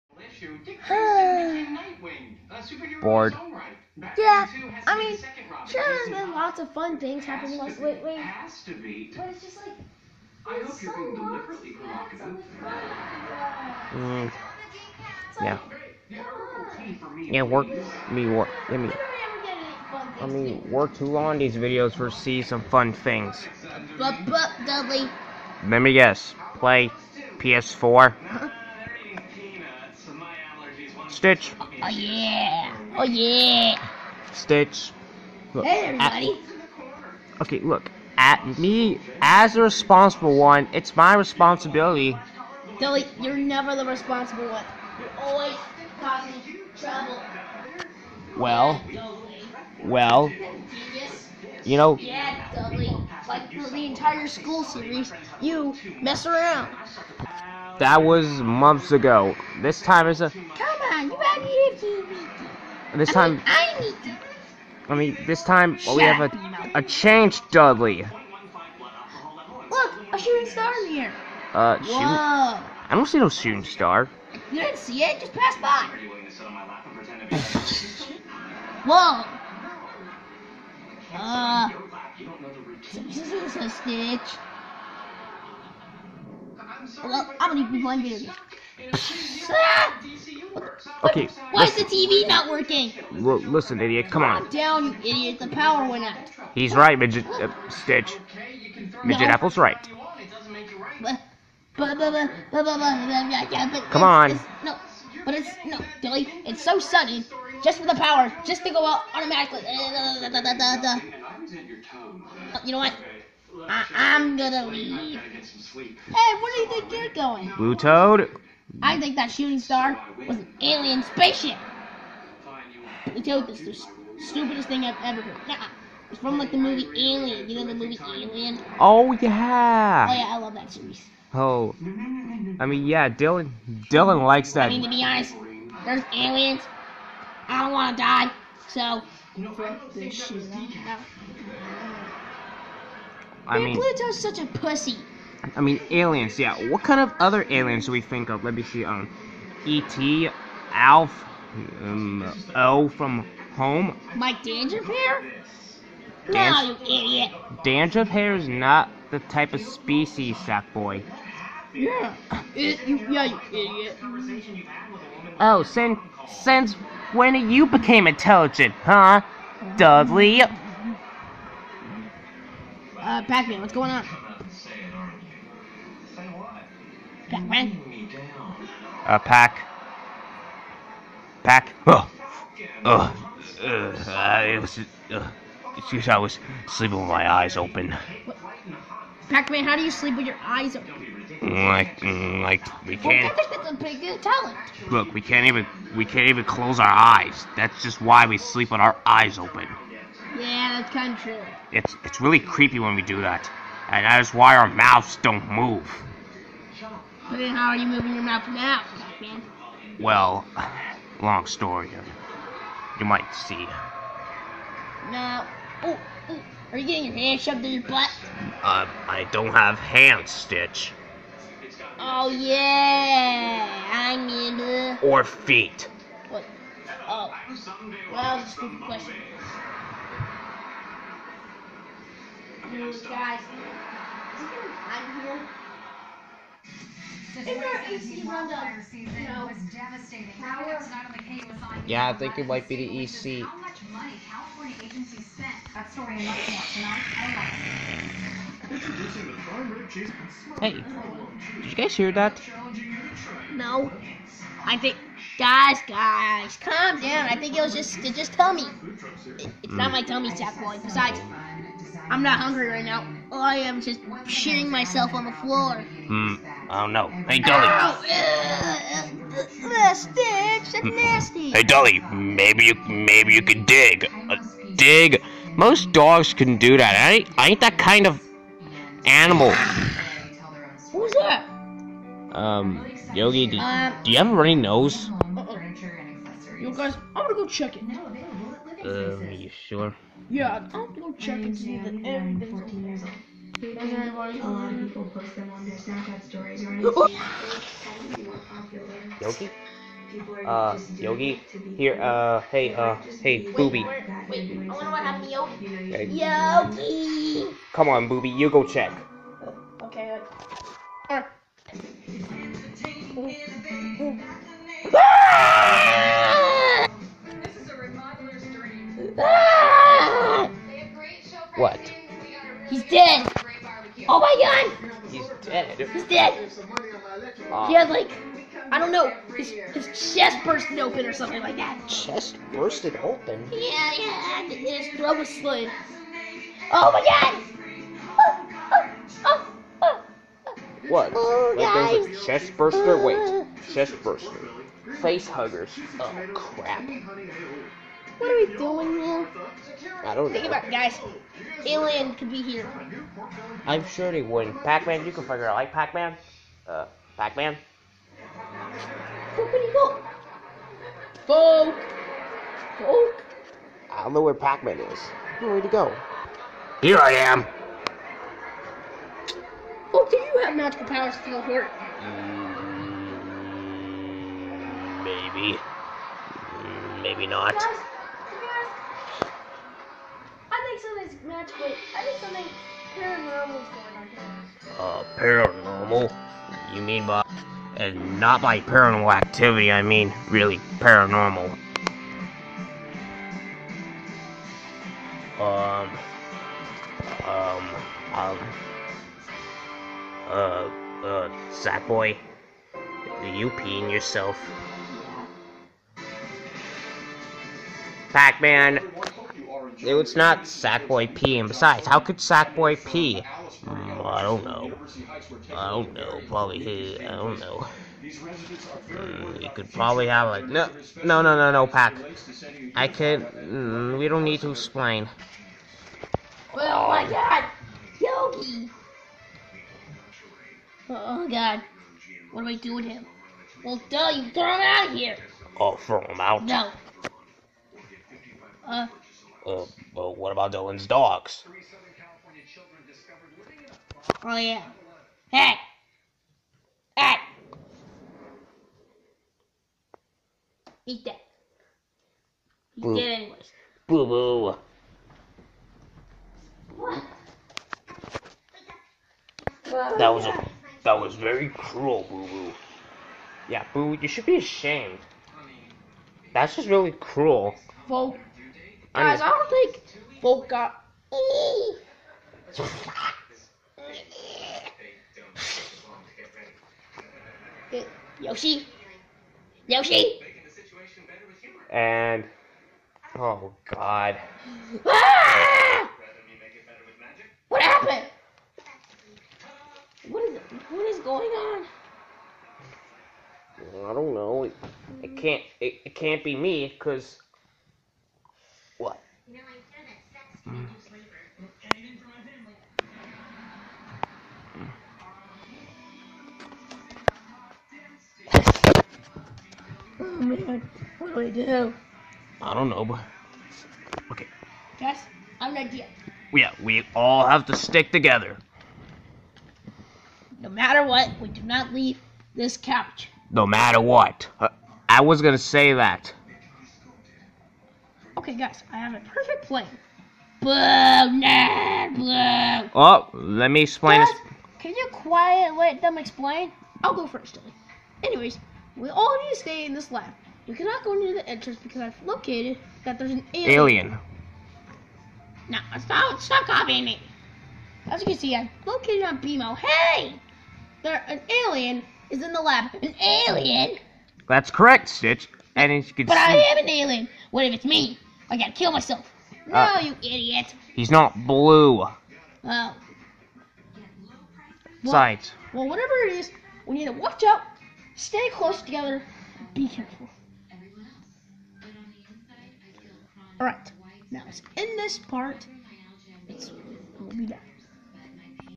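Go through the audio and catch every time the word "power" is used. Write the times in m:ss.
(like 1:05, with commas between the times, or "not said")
1:35, 1:47, 6:10.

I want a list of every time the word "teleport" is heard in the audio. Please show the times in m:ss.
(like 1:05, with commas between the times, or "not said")
6:11.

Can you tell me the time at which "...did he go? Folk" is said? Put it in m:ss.
5:59.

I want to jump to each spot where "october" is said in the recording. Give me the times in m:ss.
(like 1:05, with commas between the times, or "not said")
not said.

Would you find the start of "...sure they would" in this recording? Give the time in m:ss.
5:53.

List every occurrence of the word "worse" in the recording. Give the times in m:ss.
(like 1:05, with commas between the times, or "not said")
not said.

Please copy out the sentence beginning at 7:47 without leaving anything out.
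Well, Guys, I don't think Volk got.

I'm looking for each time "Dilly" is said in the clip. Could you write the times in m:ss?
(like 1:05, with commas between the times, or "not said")
0:42, 1:46, 8:57.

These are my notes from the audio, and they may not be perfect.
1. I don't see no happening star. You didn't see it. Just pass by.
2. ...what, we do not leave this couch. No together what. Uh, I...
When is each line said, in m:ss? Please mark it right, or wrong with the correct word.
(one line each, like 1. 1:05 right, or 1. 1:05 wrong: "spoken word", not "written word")
1. 1:12 wrong: "shooting", not "happening"
2. 8:40 wrong: "matter", not "together".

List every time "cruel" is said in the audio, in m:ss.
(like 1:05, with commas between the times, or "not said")
7:41, 7:46.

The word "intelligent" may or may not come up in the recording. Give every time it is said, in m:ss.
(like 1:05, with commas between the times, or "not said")
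2:48.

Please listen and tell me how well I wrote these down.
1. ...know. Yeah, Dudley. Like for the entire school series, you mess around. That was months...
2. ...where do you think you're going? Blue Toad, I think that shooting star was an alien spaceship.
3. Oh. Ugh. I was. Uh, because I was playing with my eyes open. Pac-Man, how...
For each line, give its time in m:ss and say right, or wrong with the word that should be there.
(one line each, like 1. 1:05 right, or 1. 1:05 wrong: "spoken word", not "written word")
1. 0:51 right
2. 1:56 right
3. 3:03 wrong: "sleeping", not "playing".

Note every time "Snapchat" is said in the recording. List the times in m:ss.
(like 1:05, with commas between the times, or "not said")
4:55.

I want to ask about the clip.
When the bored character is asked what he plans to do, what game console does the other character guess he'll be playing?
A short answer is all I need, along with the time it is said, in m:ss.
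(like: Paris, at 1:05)
PS4, at 0:27.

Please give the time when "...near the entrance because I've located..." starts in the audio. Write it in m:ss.
9:00.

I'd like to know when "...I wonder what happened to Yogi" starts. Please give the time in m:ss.
5:04.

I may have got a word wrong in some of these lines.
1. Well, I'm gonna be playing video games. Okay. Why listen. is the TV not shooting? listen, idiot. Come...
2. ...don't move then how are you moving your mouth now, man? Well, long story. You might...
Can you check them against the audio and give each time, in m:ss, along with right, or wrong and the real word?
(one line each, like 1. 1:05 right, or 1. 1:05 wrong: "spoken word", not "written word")
1. 1:27 wrong: "working", not "shooting"
2. 3:25 right.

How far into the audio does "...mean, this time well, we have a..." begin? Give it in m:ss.
1:04.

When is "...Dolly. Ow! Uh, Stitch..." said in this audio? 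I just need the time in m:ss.
4:27.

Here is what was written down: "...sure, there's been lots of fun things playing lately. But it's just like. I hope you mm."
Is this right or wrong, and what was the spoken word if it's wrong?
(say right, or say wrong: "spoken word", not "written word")
wrong: "happening", not "playing".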